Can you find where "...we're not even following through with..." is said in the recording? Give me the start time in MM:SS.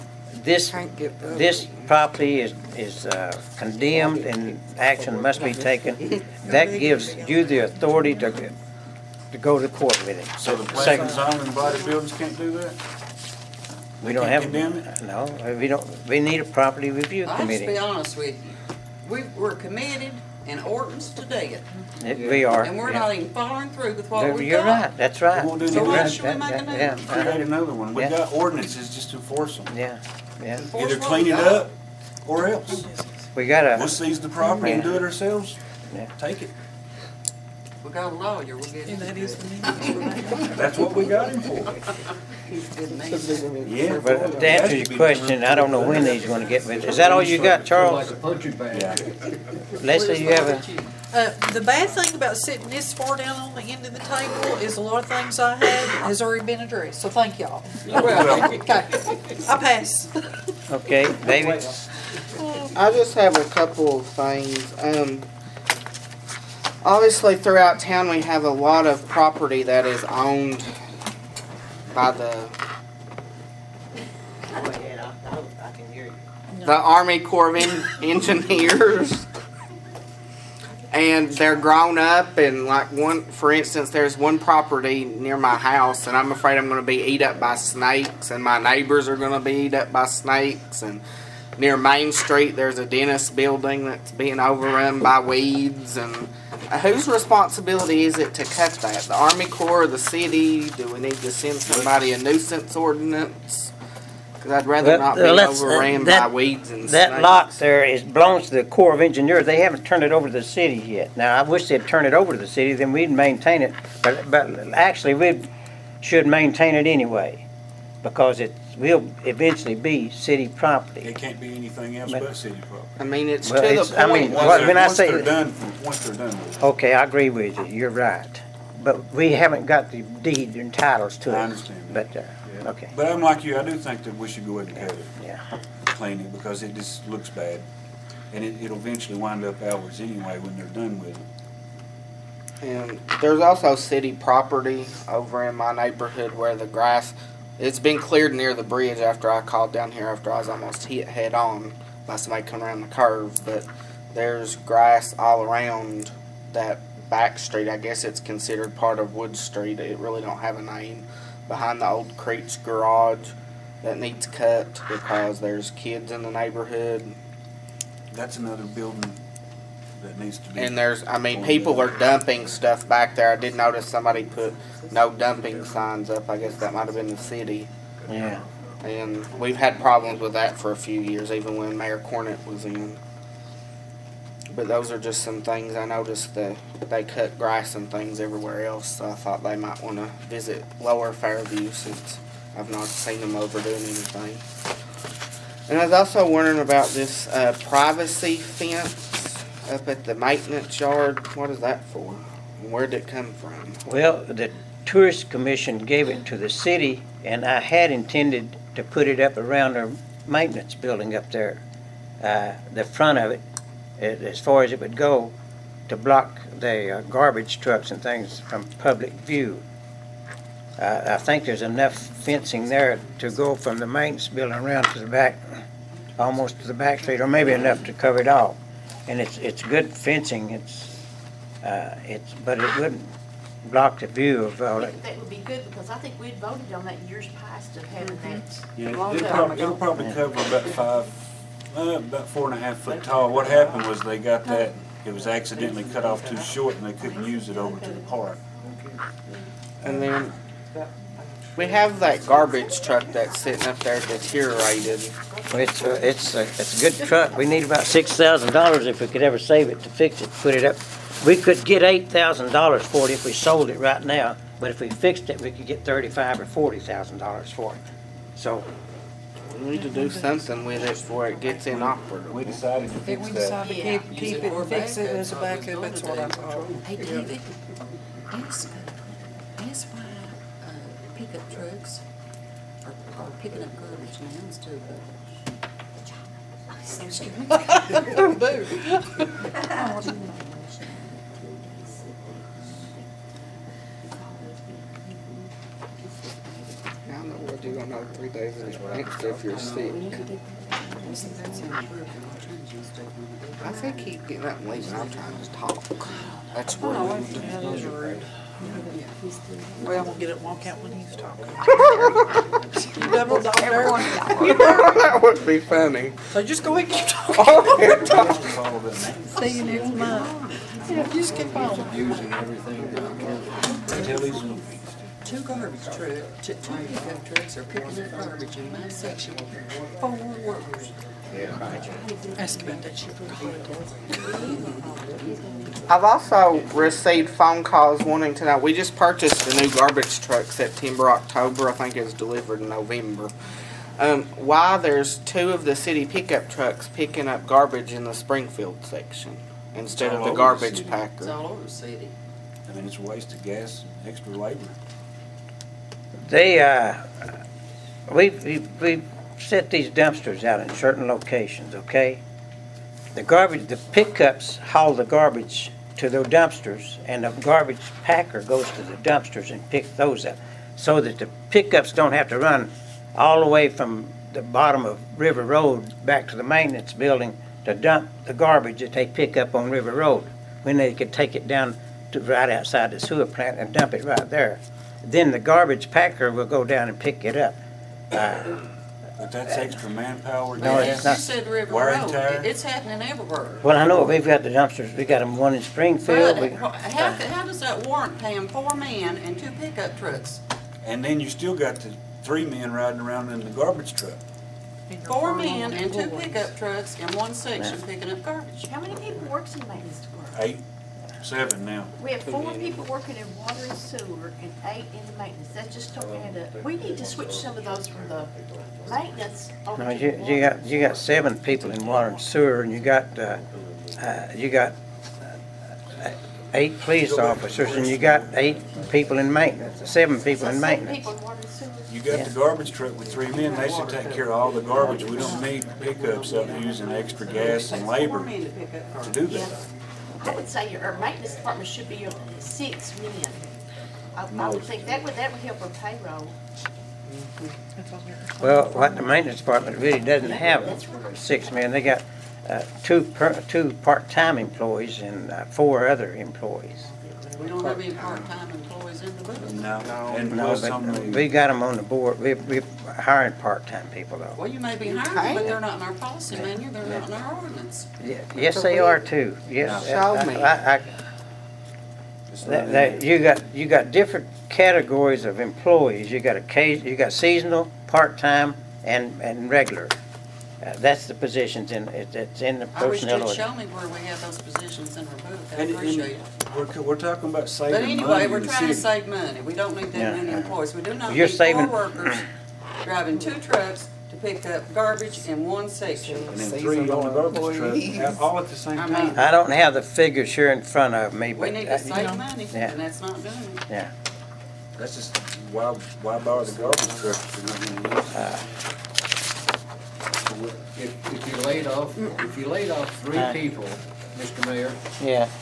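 00:22.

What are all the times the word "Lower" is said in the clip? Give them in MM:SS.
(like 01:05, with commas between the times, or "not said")
03:10.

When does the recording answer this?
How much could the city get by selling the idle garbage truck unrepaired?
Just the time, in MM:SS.
04:21.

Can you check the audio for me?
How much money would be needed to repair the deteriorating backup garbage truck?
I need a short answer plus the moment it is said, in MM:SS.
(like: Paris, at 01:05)
$6,000, at 04:17.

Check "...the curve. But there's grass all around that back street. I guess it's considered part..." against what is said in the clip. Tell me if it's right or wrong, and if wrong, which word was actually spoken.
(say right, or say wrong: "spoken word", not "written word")
right.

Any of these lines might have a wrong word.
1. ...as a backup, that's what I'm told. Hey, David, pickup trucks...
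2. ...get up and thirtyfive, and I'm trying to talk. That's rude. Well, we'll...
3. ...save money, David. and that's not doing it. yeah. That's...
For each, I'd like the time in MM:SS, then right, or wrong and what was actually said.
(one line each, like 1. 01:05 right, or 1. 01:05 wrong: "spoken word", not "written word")
1. 04:35 right
2. 05:04 wrong: "leave", not "thirtyfive"
3. 08:21 wrong: "Yeah", not "David".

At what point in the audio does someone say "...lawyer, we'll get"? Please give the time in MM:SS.
00:38.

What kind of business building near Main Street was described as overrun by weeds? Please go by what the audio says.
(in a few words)
A dentist building.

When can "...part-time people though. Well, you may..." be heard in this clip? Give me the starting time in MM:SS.
07:43.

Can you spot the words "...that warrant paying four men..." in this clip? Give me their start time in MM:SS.
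06:37.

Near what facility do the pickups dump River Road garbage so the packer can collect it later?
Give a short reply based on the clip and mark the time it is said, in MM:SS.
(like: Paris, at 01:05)
The sewer plant, at 06:23.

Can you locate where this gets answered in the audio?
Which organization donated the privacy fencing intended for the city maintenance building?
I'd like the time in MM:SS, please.
03:24.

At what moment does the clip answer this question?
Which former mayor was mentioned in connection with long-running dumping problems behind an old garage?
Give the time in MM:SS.
03:01.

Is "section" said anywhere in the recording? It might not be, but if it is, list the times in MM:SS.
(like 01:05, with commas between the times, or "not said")
05:28, 05:48, 06:47, 08:15.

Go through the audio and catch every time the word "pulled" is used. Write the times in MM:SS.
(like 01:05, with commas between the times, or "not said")
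not said.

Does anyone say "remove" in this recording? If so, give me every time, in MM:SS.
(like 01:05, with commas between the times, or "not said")
08:05.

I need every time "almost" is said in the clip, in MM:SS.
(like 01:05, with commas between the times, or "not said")
02:30, 03:46.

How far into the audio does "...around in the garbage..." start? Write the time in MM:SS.
06:43.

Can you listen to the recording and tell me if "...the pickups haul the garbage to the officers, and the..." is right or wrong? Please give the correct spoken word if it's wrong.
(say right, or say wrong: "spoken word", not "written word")
wrong: "dumpsters", not "officers".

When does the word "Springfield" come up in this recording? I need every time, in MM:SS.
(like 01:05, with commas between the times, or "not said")
05:48, 06:35.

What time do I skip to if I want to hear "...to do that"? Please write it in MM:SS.
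07:18.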